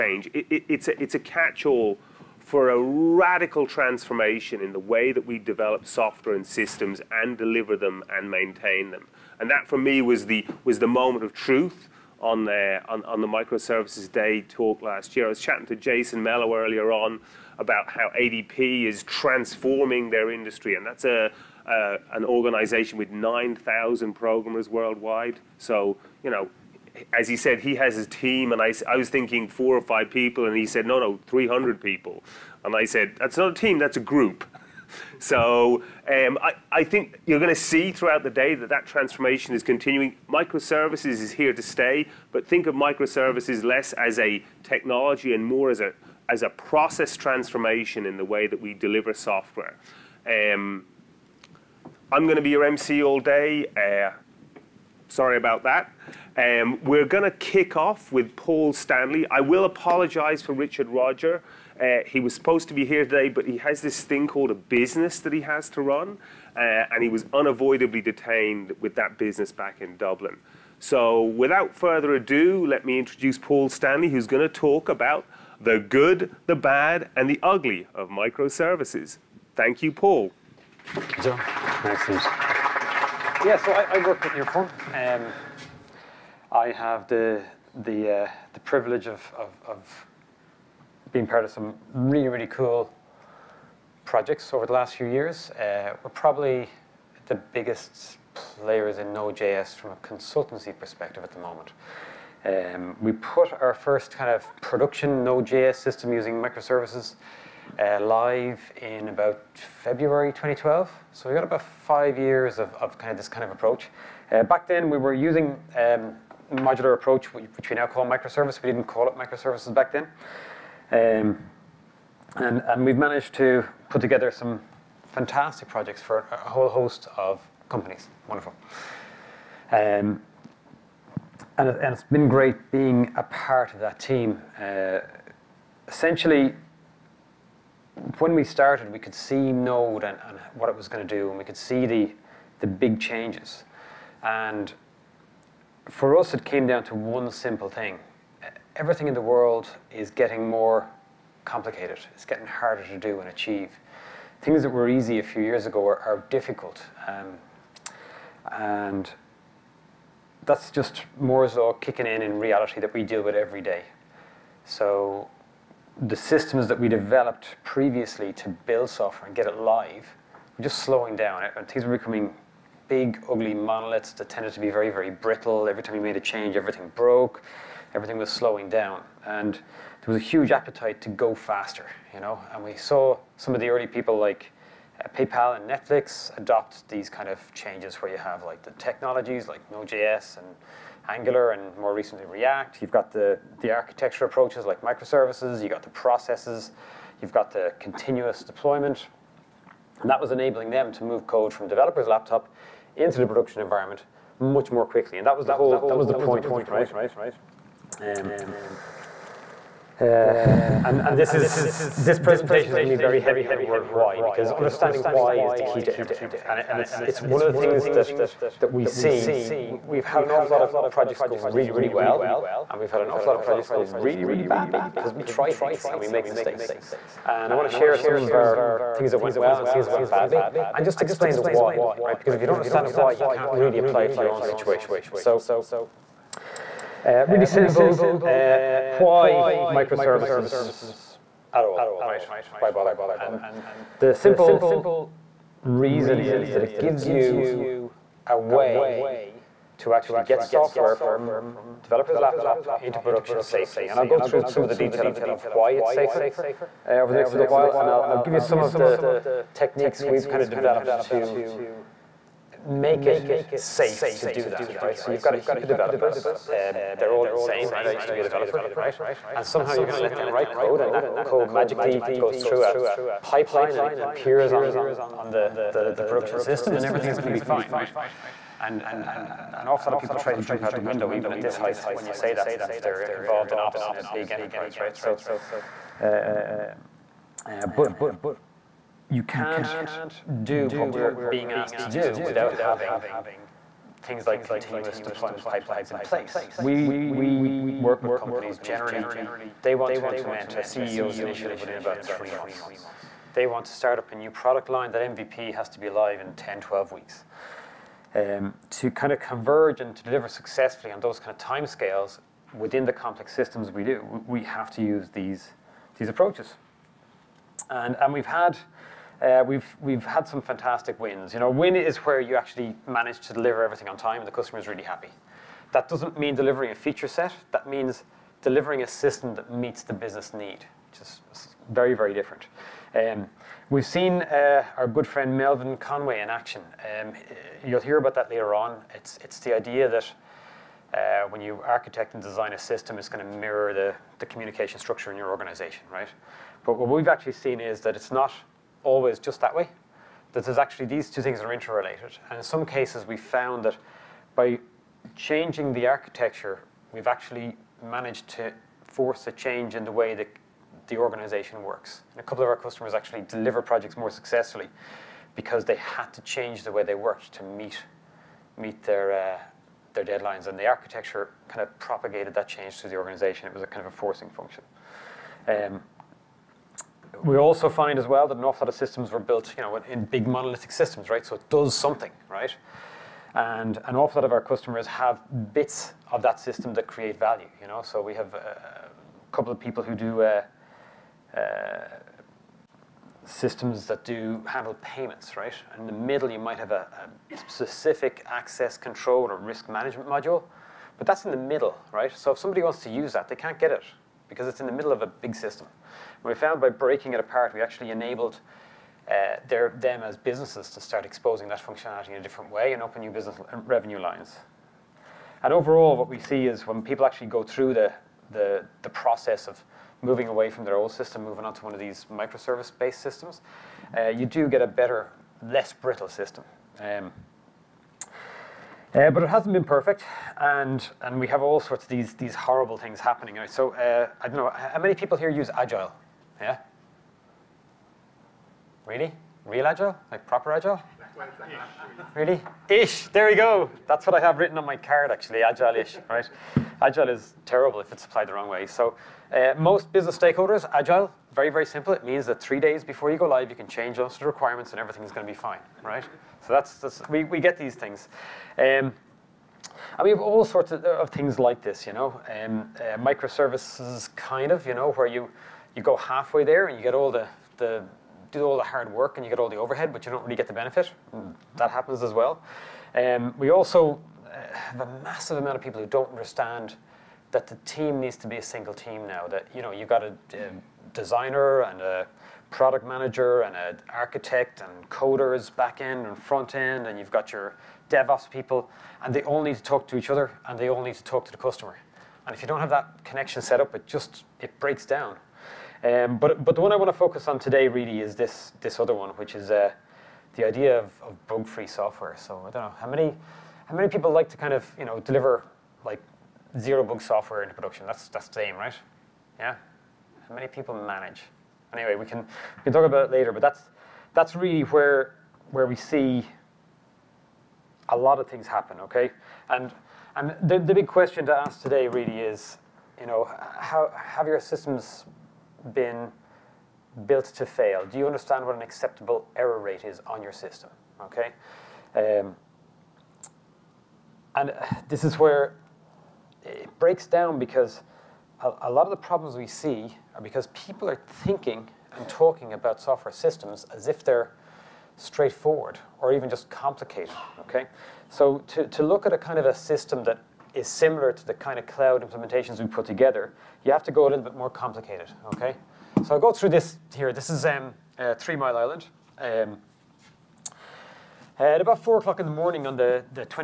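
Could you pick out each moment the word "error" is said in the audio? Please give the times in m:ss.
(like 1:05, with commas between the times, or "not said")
8:49.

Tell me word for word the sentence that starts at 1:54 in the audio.
Uh, back then we were using um, modular approach, which we now call microservice.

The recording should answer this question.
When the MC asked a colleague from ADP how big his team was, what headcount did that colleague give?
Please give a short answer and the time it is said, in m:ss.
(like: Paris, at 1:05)
300 people, at 0:31.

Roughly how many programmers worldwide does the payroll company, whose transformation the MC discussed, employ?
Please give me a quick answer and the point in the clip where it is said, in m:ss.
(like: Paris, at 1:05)
9,000, at 0:23.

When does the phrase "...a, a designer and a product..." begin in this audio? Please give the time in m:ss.
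8:00.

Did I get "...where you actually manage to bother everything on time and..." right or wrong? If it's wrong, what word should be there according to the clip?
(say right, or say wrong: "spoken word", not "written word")
wrong: "deliver", not "bother".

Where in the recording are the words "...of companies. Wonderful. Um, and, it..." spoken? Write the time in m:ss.
2:07.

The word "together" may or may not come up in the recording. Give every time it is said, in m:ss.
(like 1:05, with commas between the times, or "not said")
2:04, 9:12.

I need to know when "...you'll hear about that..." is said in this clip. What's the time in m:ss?
5:37.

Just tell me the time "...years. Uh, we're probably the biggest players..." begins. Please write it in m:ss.
1:35.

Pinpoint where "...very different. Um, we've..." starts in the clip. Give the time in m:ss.
5:31.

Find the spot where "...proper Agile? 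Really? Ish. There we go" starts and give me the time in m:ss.
7:20.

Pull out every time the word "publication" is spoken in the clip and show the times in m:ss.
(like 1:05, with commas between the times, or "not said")
not said.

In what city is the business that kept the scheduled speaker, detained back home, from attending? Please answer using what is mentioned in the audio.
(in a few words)
Dublin.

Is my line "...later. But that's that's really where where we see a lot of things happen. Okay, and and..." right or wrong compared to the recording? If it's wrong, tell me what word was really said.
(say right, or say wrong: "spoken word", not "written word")
right.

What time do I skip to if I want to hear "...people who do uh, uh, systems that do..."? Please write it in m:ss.
6:29.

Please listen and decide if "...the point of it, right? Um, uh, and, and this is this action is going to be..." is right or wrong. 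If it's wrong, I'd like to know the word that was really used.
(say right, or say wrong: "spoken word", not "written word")
wrong: "presentation", not "action".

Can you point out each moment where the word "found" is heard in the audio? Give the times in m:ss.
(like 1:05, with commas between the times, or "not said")
5:53, 6:46.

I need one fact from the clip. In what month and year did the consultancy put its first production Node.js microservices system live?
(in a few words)
February 2012.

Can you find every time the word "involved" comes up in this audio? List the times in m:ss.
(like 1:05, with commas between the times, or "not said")
4:43.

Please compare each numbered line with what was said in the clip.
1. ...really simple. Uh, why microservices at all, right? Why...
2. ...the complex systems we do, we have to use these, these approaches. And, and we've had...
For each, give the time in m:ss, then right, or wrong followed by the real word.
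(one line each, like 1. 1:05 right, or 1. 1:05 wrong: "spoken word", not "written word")
1. 3:57 right
2. 5:12 right.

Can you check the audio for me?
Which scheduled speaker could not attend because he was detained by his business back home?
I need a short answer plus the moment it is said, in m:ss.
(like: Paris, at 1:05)
Richard Rodger, at 1:00.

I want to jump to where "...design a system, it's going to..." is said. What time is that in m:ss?
5:42.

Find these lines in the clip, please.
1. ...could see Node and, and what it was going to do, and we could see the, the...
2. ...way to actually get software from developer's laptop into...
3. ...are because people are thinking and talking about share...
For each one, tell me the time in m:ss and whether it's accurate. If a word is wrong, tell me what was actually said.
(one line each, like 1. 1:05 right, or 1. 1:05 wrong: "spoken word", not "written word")
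1. 2:18 right
2. 4:08 right
3. 9:00 wrong: "software", not "share".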